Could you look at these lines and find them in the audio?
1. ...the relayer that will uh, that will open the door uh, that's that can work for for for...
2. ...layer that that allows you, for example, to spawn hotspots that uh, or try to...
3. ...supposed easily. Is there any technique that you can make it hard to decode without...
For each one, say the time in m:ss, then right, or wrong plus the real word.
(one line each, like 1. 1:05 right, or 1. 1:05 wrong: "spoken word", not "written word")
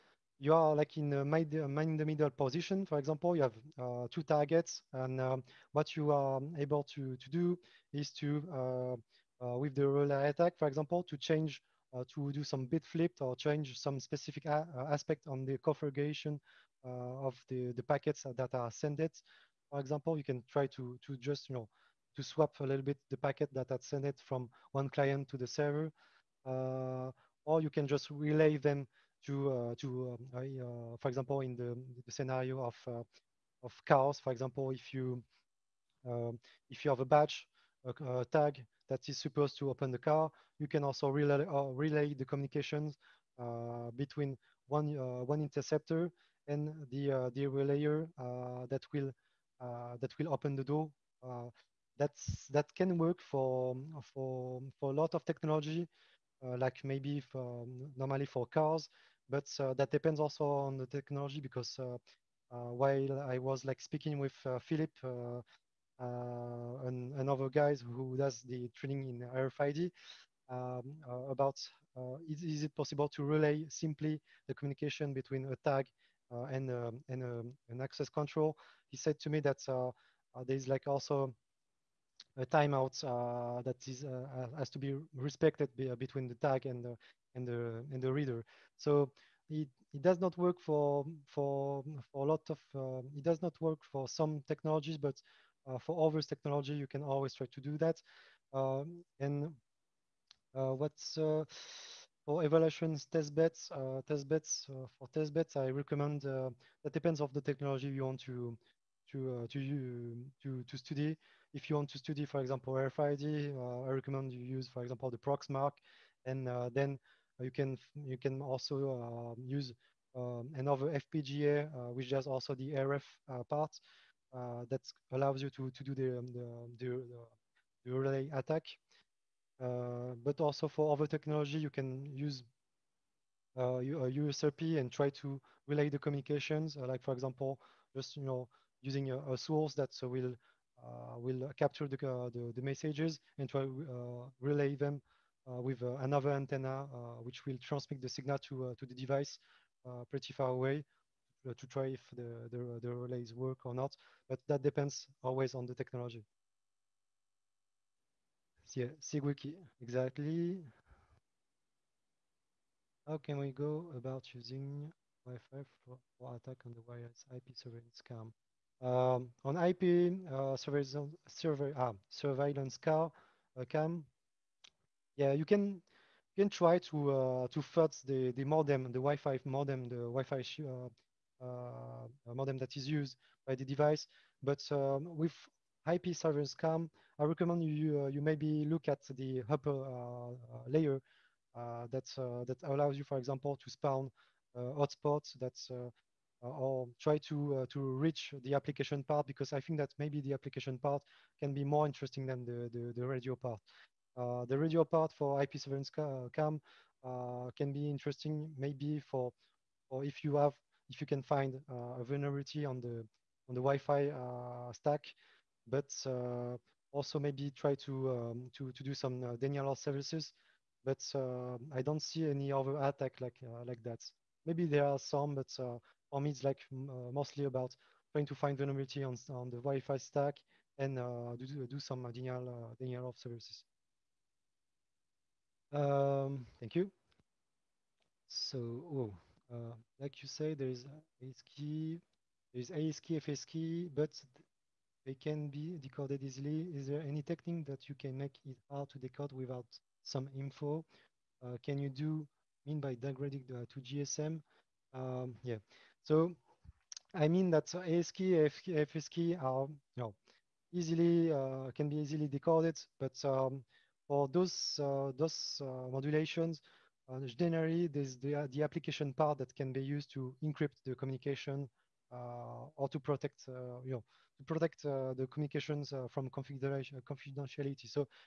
1. 0:47 right
2. 3:10 right
3. 4:05 wrong: "decoded", not "supposed".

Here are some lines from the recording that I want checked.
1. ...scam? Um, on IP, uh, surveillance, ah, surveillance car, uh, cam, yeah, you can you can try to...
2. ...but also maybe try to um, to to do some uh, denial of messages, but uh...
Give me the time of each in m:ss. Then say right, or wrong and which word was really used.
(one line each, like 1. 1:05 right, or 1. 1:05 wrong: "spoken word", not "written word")
1. 2:48 right
2. 3:35 wrong: "services", not "messages".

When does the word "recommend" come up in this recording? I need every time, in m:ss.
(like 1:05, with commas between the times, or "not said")
1:45, 1:53, 3:07.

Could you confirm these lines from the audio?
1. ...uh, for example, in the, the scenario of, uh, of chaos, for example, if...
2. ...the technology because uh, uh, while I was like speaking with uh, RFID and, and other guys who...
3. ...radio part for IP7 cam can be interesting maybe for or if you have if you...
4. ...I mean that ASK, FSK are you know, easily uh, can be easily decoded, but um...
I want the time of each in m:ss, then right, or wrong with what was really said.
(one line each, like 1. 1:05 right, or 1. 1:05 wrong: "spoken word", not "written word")
1. 0:30 right
2. 1:00 wrong: "Philip", not "RFID"
3. 3:24 right
4. 4:17 right.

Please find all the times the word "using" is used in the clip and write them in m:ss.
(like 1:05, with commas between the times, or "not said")
2:18, 2:44.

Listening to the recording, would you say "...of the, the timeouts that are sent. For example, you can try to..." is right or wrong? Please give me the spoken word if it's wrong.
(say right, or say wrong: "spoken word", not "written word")
wrong: "packets", not "timeouts".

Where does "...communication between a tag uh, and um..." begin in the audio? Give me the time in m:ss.
1:14.